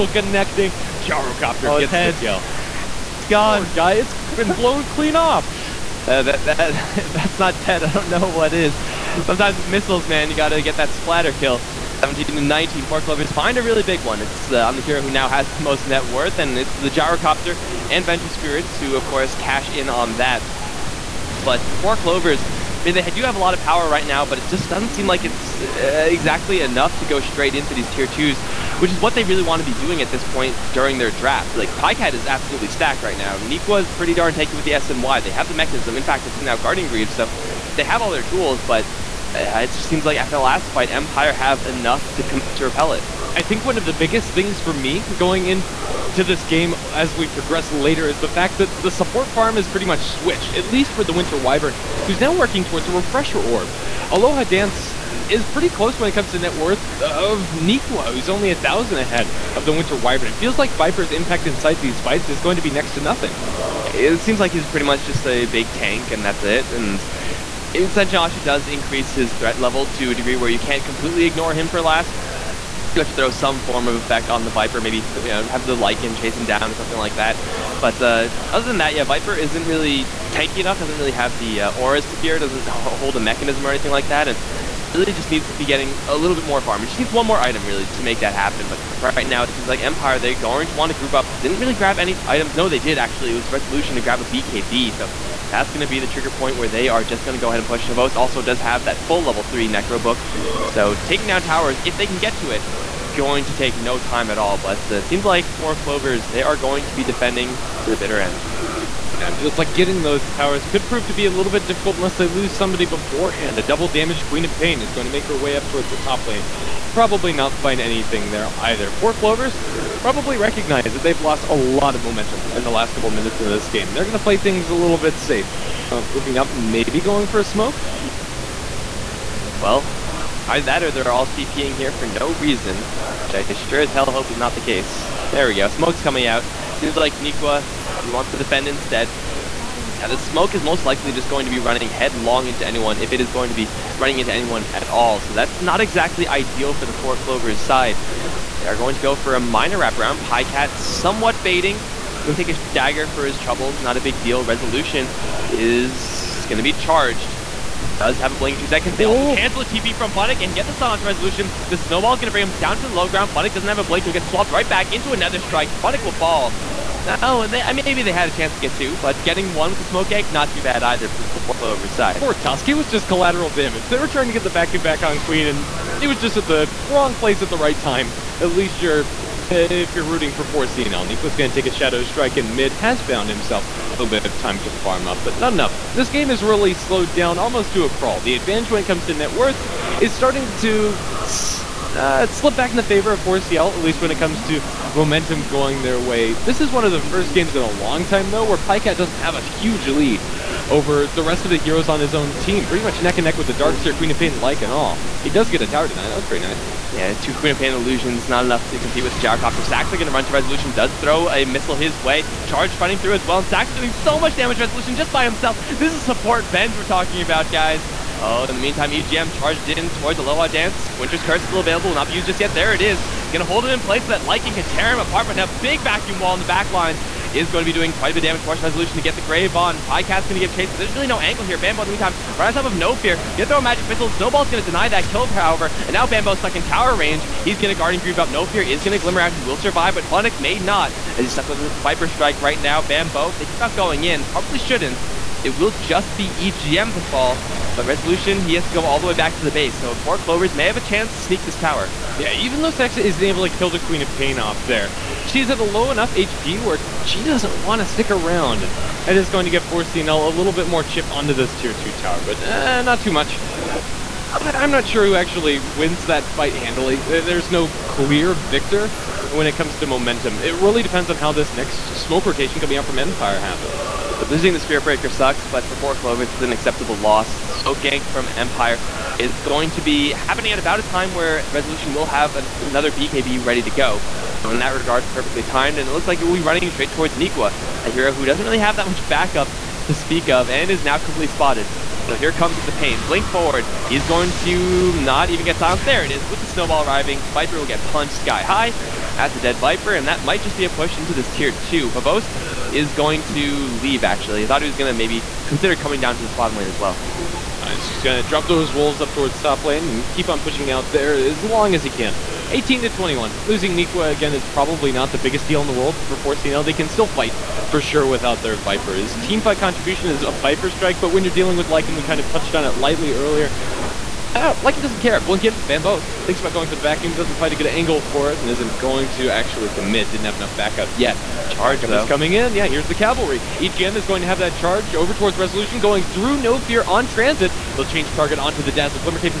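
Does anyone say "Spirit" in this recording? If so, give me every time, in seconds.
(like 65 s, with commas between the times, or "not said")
18 s, 274 s.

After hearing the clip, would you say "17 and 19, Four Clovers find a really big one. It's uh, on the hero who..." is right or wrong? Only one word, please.
right.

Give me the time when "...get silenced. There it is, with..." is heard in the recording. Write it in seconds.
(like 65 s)
295 s.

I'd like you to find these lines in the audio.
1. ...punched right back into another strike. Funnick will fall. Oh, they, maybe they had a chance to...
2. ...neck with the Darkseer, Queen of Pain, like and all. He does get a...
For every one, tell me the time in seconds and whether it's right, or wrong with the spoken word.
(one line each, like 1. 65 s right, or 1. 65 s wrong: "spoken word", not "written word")
1. 164 s wrong: "swapped", not "punched"
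2. 203 s right.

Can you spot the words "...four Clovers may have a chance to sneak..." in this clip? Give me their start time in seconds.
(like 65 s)
249 s.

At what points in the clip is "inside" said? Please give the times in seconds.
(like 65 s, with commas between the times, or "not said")
61 s, 67 s.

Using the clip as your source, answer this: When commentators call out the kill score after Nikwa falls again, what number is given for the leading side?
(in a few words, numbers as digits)
21.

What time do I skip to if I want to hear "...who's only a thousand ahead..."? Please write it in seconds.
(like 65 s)
58 s.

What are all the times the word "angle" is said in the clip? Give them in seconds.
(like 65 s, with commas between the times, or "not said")
231 s, 327 s.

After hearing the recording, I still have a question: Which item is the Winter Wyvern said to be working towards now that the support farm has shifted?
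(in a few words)
Refresher Orb.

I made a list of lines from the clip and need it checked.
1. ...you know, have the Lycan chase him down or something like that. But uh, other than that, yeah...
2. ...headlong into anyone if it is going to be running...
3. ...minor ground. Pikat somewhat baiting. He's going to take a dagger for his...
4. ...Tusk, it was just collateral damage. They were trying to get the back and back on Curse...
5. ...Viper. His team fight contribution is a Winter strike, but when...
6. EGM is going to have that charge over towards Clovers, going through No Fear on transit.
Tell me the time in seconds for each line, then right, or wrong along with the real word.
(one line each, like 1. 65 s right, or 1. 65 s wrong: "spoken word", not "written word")
1. 74 s right
2. 141 s right
3. 149 s wrong: "wraparound", not "ground"
4. 172 s wrong: "Queen", not "Curse"
5. 318 s wrong: "Viper", not "Winter"
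6. 333 s wrong: "Resolution", not "Clovers".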